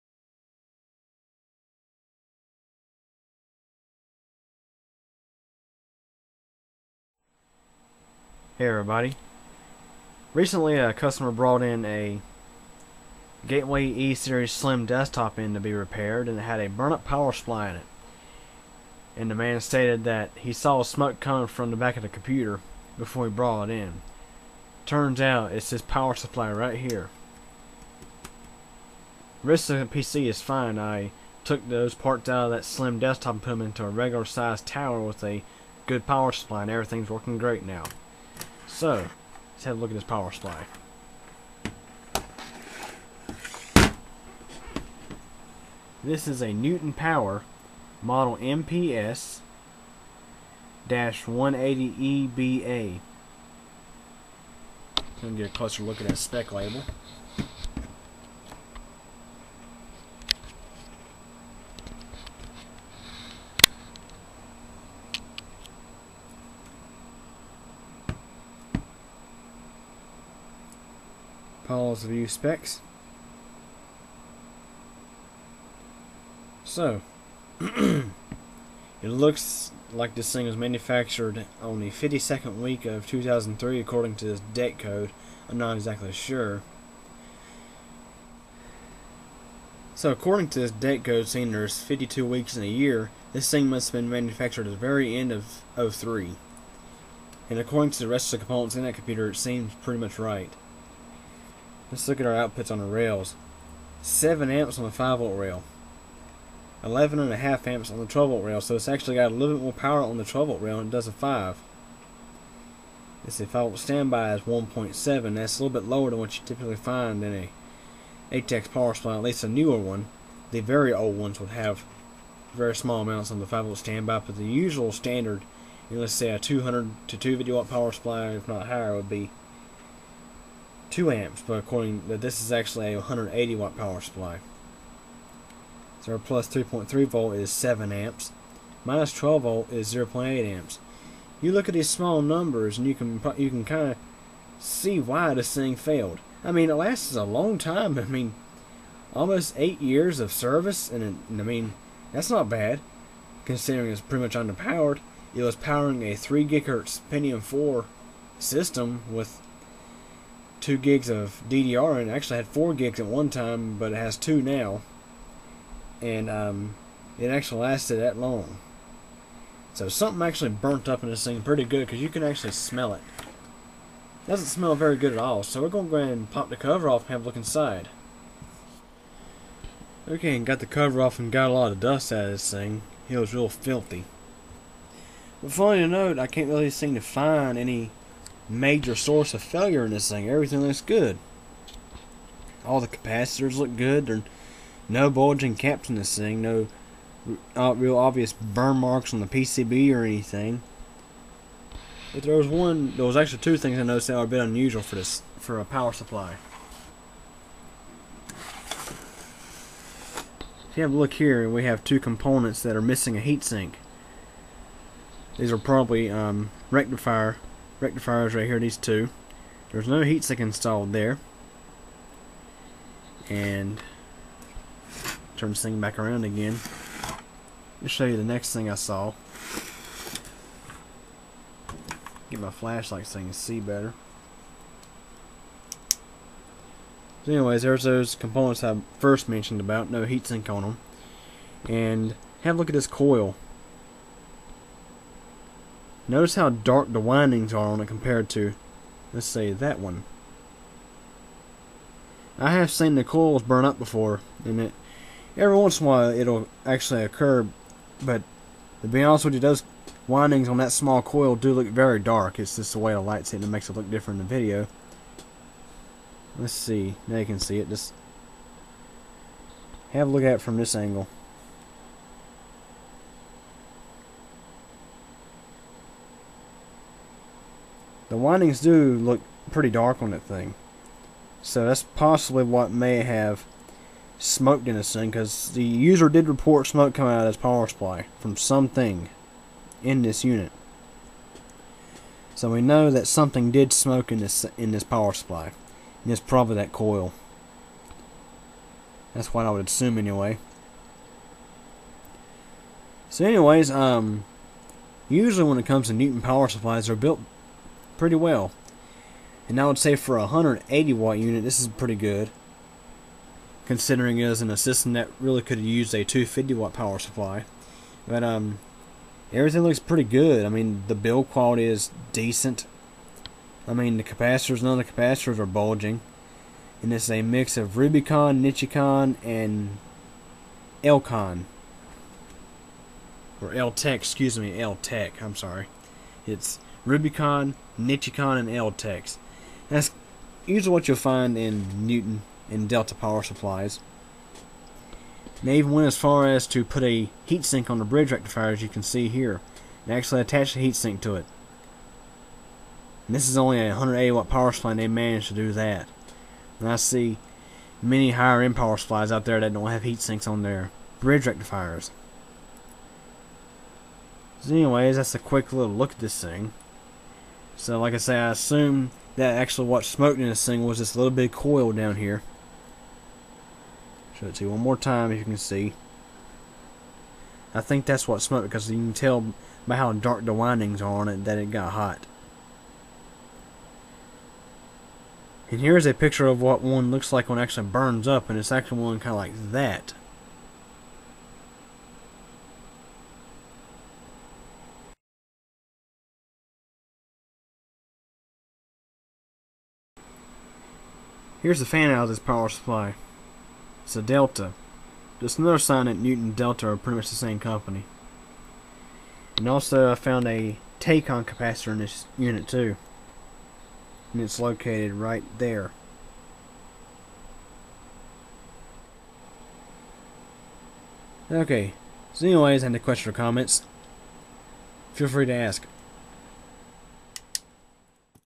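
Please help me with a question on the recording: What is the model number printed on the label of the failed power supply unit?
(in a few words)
MPS 180EBA.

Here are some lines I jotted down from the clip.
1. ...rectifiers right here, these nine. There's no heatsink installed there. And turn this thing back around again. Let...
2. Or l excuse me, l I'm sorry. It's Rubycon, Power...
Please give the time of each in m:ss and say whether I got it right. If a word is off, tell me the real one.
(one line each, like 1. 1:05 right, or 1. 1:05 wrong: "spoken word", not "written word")
1. 3:37 wrong: "two", not "nine"
2. 5:33 wrong: "Nichicon", not "Power".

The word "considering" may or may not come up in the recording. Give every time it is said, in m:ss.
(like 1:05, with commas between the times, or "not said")
2:33, 5:13.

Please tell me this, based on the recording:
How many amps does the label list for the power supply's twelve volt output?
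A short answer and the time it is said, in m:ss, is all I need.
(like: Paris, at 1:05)
11.5 amps, at 1:46.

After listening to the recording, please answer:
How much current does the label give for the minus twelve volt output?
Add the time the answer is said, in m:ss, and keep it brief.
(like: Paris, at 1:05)
0.8 amps, at 2:19.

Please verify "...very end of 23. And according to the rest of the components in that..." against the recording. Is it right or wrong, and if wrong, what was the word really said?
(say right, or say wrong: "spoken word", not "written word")
wrong: "03", not "23".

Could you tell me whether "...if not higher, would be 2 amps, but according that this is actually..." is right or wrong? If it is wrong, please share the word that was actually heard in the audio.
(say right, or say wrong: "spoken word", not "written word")
right.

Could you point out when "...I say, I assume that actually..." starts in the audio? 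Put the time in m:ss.
6:07.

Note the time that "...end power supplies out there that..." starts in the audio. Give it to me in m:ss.
5:58.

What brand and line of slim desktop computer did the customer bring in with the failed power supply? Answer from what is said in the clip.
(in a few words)
Gateway E-Series.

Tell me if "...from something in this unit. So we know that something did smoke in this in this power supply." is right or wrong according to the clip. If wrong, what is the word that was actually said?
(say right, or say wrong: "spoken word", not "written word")
right.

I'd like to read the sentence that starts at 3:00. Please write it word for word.
Okay, and got the cover off and got a lot of dust out of this thing.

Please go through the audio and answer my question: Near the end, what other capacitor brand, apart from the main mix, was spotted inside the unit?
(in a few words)
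Tacon.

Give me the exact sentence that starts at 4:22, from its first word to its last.
It's just the way the light's hitting it makes it look different in the video.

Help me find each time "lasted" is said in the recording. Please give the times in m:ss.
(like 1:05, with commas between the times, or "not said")
2:26, 2:47.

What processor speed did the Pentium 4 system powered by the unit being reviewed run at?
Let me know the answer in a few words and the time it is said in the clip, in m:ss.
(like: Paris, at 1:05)
3 gigahertz, at 2:36.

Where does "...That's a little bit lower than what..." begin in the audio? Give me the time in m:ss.
1:55.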